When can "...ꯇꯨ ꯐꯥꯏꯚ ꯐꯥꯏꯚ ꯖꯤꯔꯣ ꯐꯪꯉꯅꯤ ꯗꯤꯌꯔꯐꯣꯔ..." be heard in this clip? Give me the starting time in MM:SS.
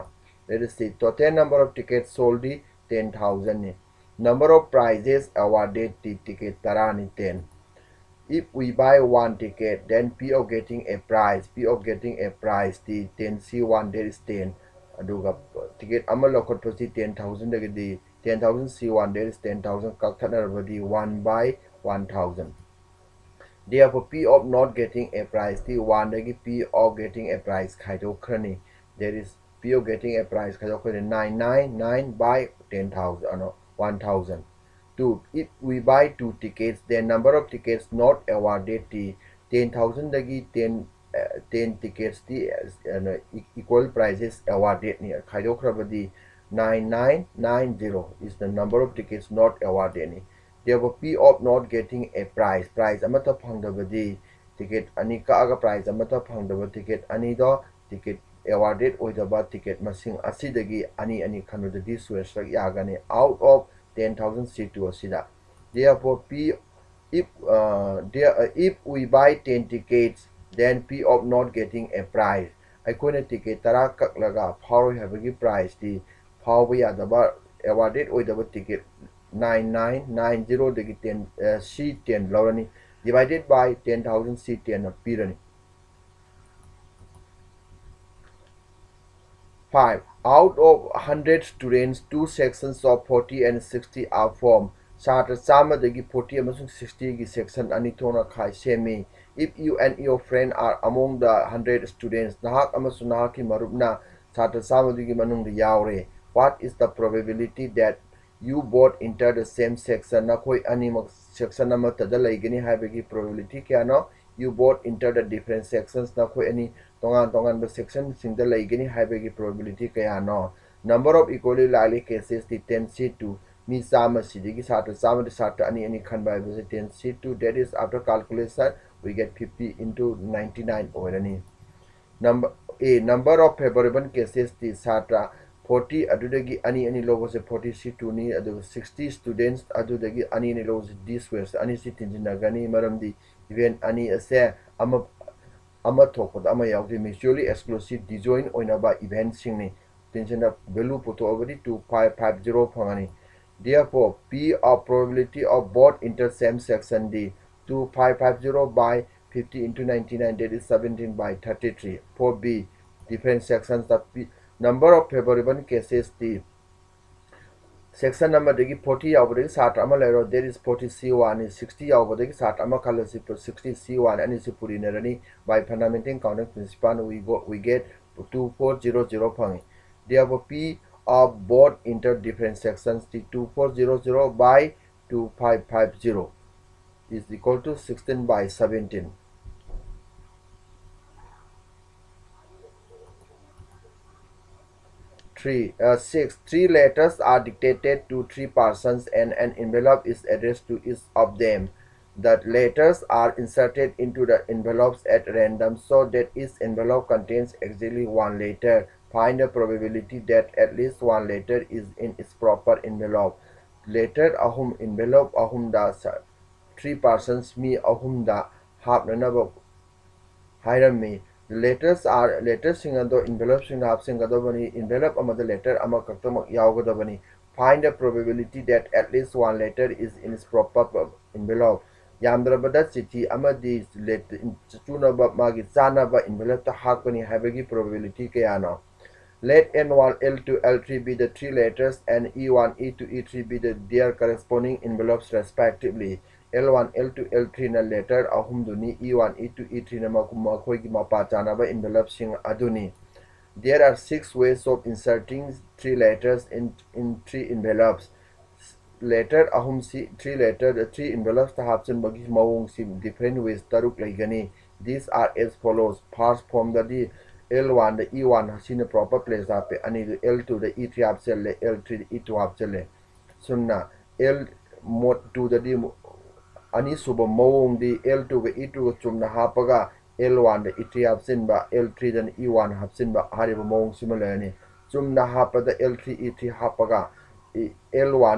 02:31.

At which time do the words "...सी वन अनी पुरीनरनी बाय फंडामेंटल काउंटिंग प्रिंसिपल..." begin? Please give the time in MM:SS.
02:53.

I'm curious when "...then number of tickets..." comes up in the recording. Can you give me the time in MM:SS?
00:36.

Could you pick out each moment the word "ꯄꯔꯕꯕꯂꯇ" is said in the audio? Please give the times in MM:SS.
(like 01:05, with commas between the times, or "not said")
01:47, 01:53.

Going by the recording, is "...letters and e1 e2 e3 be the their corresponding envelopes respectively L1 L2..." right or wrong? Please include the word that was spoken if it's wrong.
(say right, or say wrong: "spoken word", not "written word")
right.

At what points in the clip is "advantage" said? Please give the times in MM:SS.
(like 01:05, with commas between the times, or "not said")
not said.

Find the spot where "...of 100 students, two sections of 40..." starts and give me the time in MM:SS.
01:30.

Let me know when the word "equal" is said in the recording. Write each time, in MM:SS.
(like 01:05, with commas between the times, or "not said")
00:43, 03:07.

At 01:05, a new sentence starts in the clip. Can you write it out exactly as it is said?
Therefore, P if uh, there, uh, if we buy 10 tickets, then P of not getting a price.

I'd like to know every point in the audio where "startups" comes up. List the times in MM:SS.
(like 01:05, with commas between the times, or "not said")
not said.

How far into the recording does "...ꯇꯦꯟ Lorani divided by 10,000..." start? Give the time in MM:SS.
01:21.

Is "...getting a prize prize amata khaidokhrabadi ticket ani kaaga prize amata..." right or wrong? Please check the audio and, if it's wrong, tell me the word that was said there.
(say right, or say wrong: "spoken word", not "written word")
wrong: "phangdabadi", not "khaidokhrabadi".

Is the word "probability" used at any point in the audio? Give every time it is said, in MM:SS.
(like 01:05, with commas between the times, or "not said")
02:34, 03:29, 03:47, 03:57.